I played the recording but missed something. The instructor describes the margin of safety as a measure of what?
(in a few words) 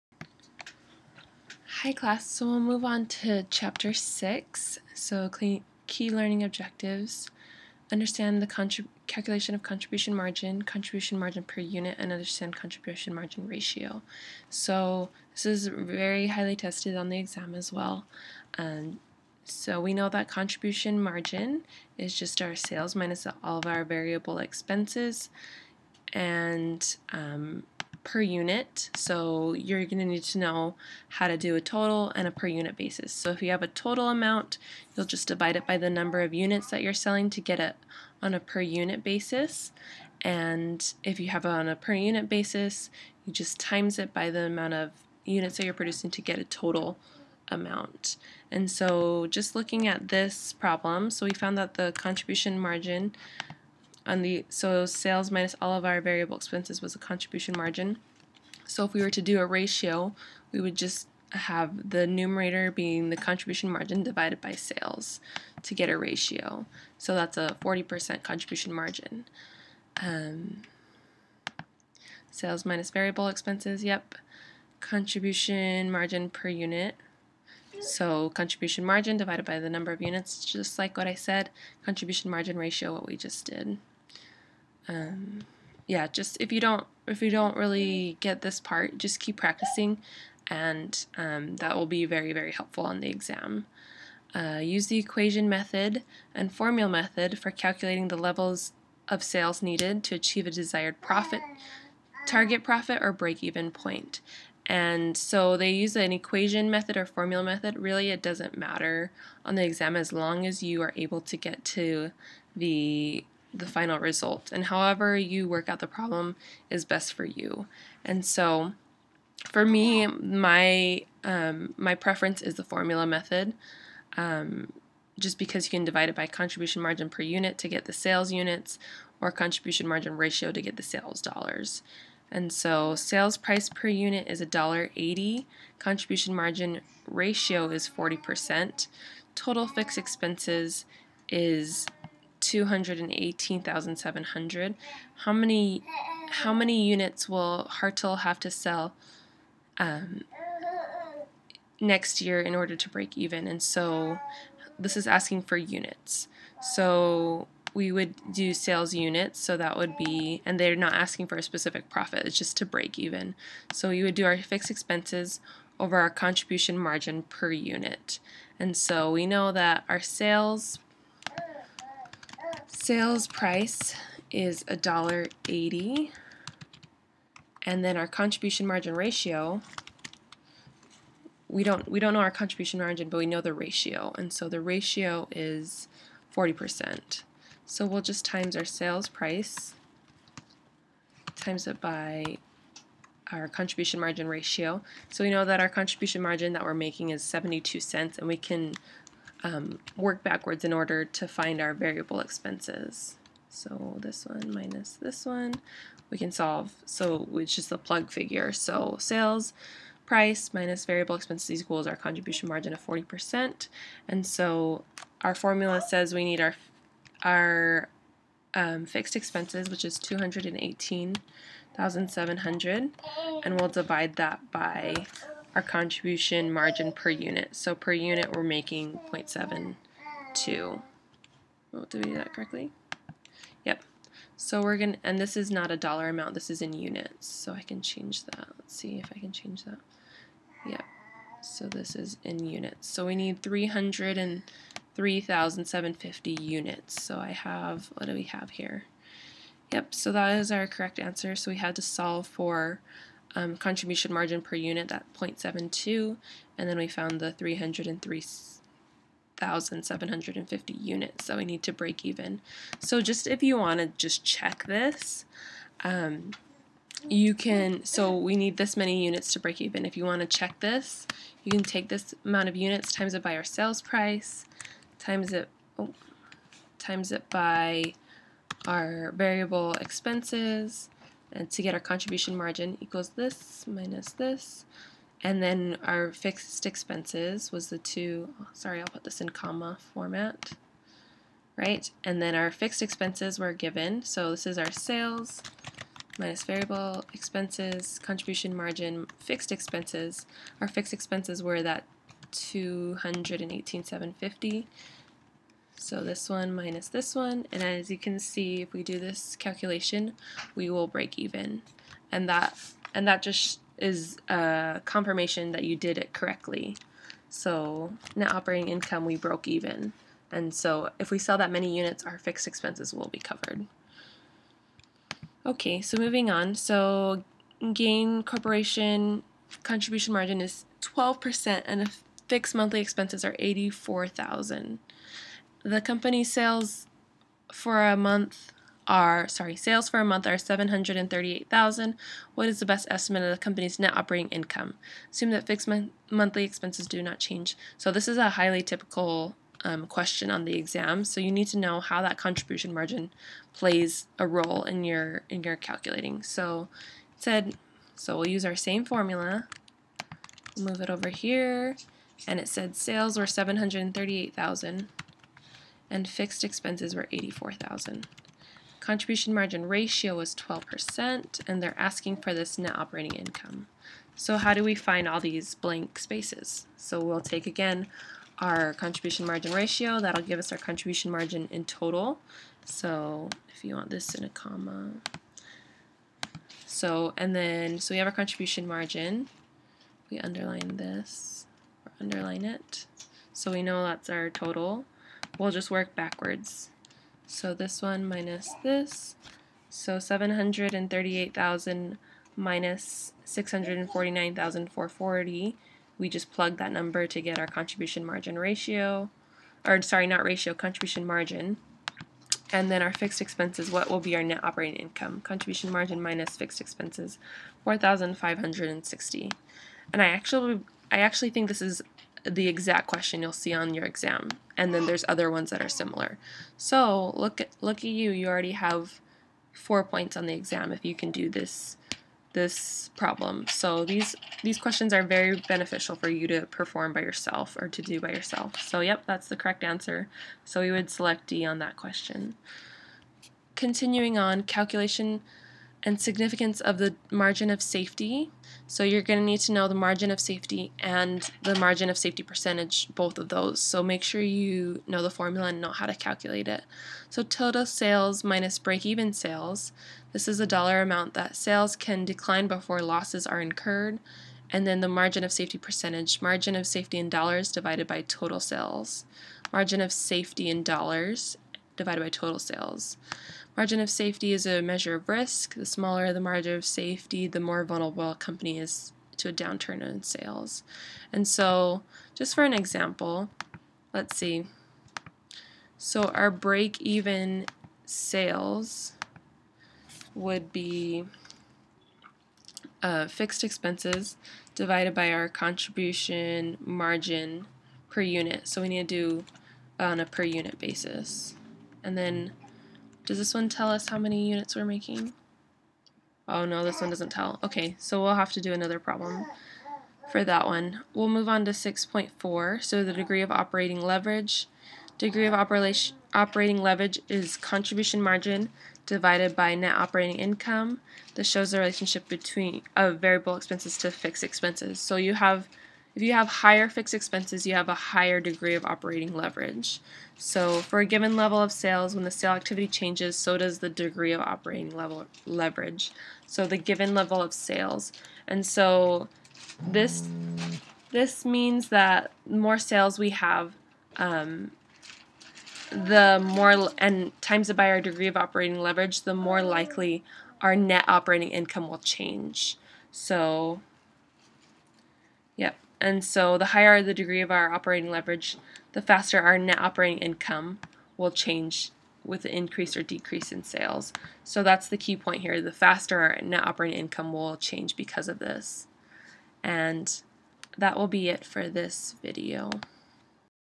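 risk.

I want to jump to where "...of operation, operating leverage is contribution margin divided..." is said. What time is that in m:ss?
8:35.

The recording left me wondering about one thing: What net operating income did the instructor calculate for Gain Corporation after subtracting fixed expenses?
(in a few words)
4,560.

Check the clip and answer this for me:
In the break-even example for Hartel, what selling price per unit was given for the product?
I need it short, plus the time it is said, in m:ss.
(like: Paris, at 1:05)
$1.80, at 2:14.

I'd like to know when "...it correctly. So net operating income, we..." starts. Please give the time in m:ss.
5:15.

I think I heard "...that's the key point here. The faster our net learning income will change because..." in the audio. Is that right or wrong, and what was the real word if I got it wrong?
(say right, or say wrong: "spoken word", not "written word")
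wrong: "operating", not "learning".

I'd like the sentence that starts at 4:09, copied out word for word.
Yep, so that is our correct answer.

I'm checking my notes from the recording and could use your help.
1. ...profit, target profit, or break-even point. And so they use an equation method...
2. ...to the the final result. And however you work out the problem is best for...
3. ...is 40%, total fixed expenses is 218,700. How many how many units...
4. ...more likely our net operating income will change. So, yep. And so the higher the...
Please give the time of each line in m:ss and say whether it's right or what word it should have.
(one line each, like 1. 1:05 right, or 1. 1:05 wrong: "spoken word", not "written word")
1. 1:41 right
2. 1:51 right
3. 2:17 right
4. 9:09 right.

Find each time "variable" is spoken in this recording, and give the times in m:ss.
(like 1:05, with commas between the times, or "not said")
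0:23, 0:56, 1:12, 3:21, 3:30, 4:39, 4:56, 8:42.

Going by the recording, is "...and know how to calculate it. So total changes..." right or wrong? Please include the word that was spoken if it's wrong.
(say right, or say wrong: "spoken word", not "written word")
wrong: "sales", not "changes".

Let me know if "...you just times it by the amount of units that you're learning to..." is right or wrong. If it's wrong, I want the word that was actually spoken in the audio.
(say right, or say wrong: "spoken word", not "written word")
wrong: "producing", not "learning".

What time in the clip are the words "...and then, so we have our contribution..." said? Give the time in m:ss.
6:27.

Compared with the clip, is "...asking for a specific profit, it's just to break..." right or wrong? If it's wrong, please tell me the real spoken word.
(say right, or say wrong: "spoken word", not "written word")
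right.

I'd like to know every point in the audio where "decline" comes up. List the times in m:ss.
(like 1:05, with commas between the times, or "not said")
7:42.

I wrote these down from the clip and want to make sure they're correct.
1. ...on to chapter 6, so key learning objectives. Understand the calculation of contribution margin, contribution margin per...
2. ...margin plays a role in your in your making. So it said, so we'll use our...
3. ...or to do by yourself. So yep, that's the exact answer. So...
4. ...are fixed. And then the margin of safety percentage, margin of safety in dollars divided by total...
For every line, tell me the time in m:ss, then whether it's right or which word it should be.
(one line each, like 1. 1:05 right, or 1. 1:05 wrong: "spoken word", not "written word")
1. 0:02 right
2. 5:52 wrong: "calculating", not "making"
3. 7:17 wrong: "correct", not "exact"
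4. 7:43 wrong: "incurred", not "fixed".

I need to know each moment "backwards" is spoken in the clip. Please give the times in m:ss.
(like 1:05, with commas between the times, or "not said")
3:20, 6:35.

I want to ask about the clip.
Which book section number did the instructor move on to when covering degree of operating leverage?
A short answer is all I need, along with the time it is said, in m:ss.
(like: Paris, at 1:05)
6.4, at 8:31.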